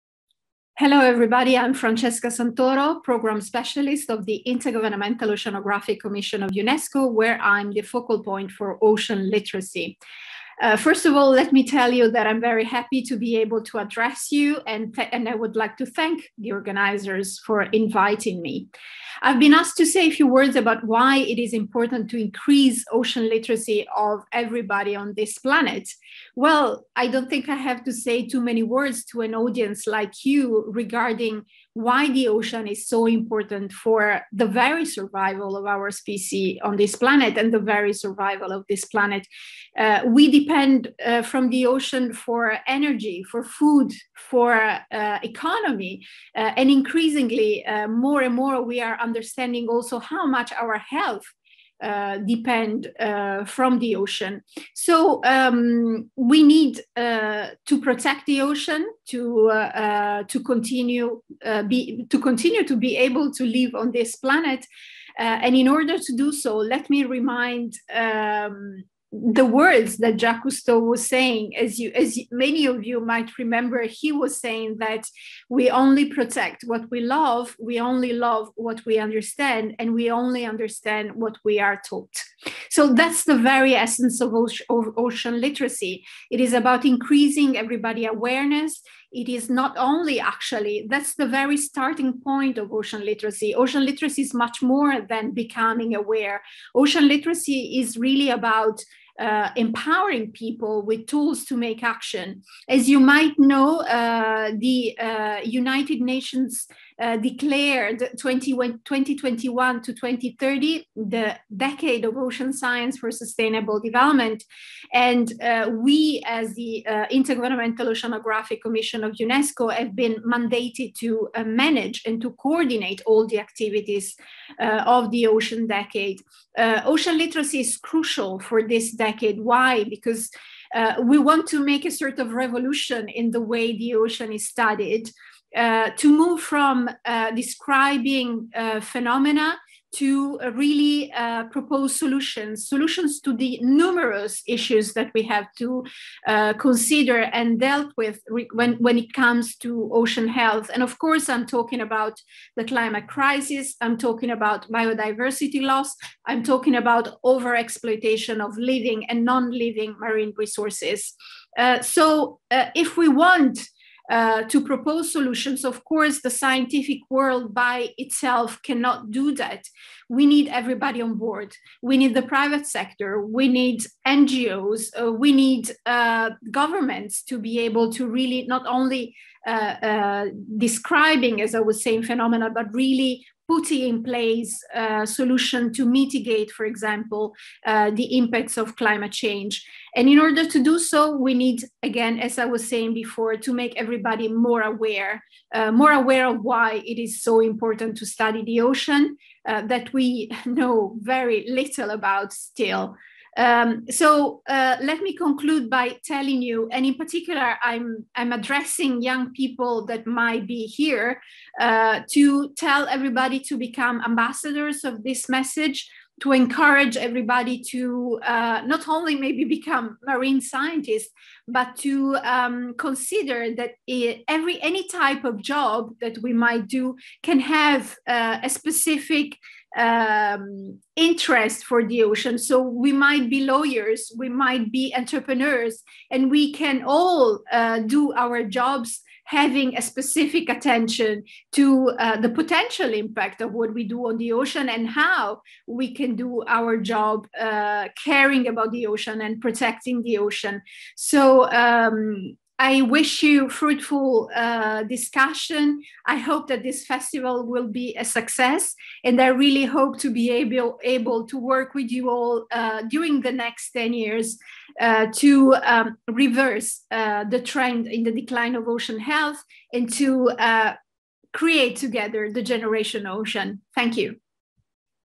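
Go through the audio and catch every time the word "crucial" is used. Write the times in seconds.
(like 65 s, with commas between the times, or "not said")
127 s.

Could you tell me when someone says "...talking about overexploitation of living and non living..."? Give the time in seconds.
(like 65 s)
156 s.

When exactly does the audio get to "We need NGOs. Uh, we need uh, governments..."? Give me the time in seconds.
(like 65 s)
173 s.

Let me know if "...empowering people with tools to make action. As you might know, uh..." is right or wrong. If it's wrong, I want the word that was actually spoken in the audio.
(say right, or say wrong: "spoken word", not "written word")
right.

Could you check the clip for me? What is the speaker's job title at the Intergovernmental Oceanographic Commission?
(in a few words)
Program Specialist.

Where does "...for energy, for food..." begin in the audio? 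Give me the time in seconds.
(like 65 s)
42 s.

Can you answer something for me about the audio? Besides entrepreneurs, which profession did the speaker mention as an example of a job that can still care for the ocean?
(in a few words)
lawyers.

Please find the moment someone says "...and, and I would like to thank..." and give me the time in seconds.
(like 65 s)
14 s.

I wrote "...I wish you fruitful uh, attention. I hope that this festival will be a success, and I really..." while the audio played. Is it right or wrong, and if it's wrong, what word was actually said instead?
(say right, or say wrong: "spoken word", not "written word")
wrong: "discussion", not "attention".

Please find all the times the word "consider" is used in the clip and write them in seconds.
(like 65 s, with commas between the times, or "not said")
146 s, 222 s.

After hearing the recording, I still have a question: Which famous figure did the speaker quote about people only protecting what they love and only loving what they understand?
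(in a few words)
Jacques Cousteau.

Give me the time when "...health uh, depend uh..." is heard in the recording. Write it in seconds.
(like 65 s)
50 s.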